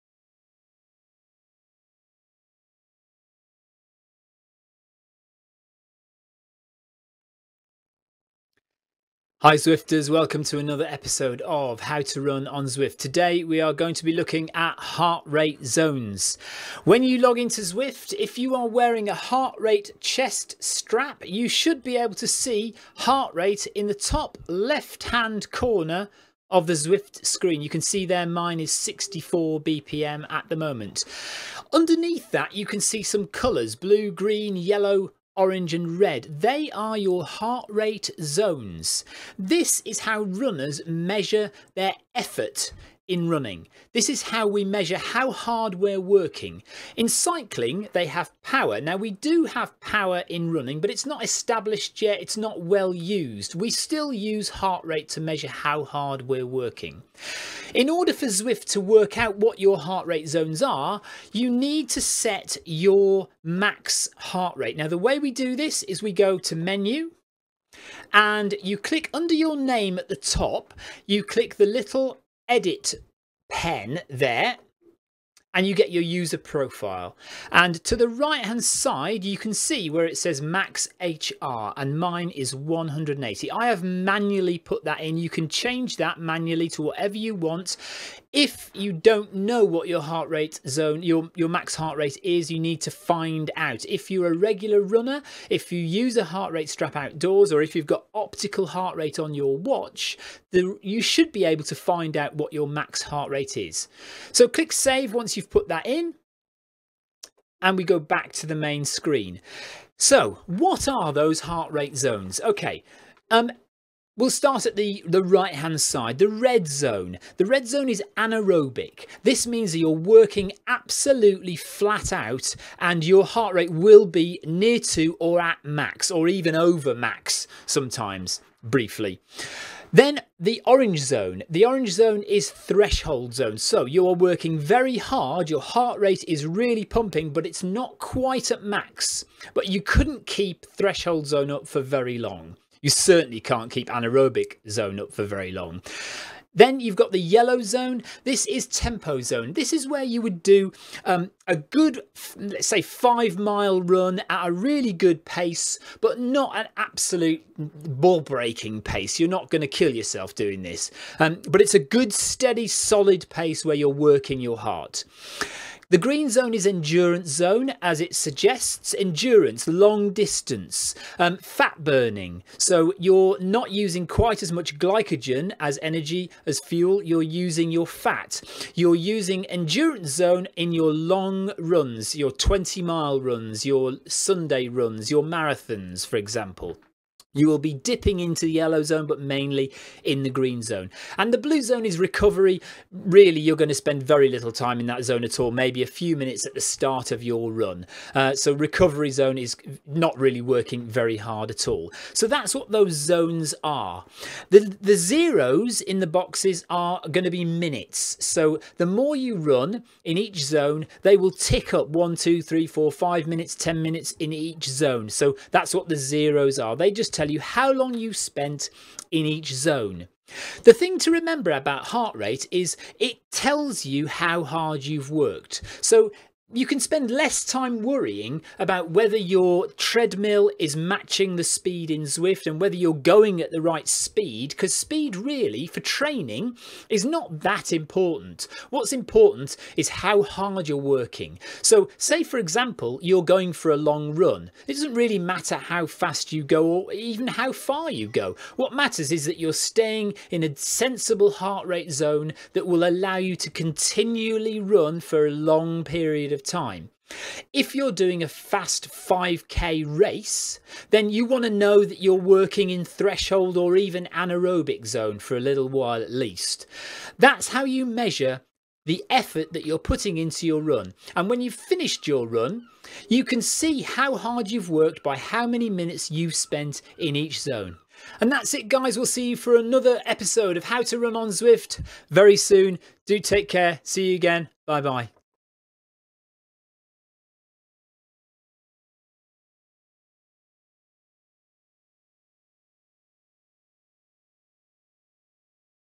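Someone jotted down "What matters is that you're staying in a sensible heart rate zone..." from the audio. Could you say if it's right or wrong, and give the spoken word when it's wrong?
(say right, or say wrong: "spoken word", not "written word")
right.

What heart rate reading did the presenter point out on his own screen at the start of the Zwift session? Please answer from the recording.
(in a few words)
64 BPM.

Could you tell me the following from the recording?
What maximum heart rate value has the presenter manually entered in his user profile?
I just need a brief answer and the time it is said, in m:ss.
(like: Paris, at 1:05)
180, at 1:22.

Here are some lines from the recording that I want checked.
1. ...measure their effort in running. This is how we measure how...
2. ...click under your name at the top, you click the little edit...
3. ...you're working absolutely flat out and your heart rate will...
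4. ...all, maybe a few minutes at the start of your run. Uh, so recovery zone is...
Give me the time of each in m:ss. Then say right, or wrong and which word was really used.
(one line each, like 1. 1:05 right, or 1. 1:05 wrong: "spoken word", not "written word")
1. 0:40 right
2. 1:08 right
3. 1:59 right
4. 3:15 right.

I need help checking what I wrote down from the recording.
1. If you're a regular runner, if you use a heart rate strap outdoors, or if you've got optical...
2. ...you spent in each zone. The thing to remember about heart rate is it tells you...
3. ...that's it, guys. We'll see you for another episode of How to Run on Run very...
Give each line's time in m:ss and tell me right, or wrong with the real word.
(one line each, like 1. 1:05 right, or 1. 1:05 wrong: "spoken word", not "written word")
1. 1:33 right
2. 3:37 right
3. 4:38 wrong: "Zwift", not "Run".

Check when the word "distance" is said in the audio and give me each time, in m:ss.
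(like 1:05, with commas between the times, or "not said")
2:50.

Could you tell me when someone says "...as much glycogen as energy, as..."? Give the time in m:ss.
2:54.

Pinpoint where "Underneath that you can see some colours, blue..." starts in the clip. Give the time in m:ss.
0:31.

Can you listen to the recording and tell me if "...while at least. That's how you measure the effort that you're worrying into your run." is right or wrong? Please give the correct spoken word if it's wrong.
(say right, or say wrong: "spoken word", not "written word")
wrong: "putting", not "worrying".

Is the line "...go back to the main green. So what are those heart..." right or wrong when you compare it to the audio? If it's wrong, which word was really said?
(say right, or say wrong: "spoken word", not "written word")
wrong: "screen", not "green".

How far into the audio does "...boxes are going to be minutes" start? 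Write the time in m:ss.
3:26.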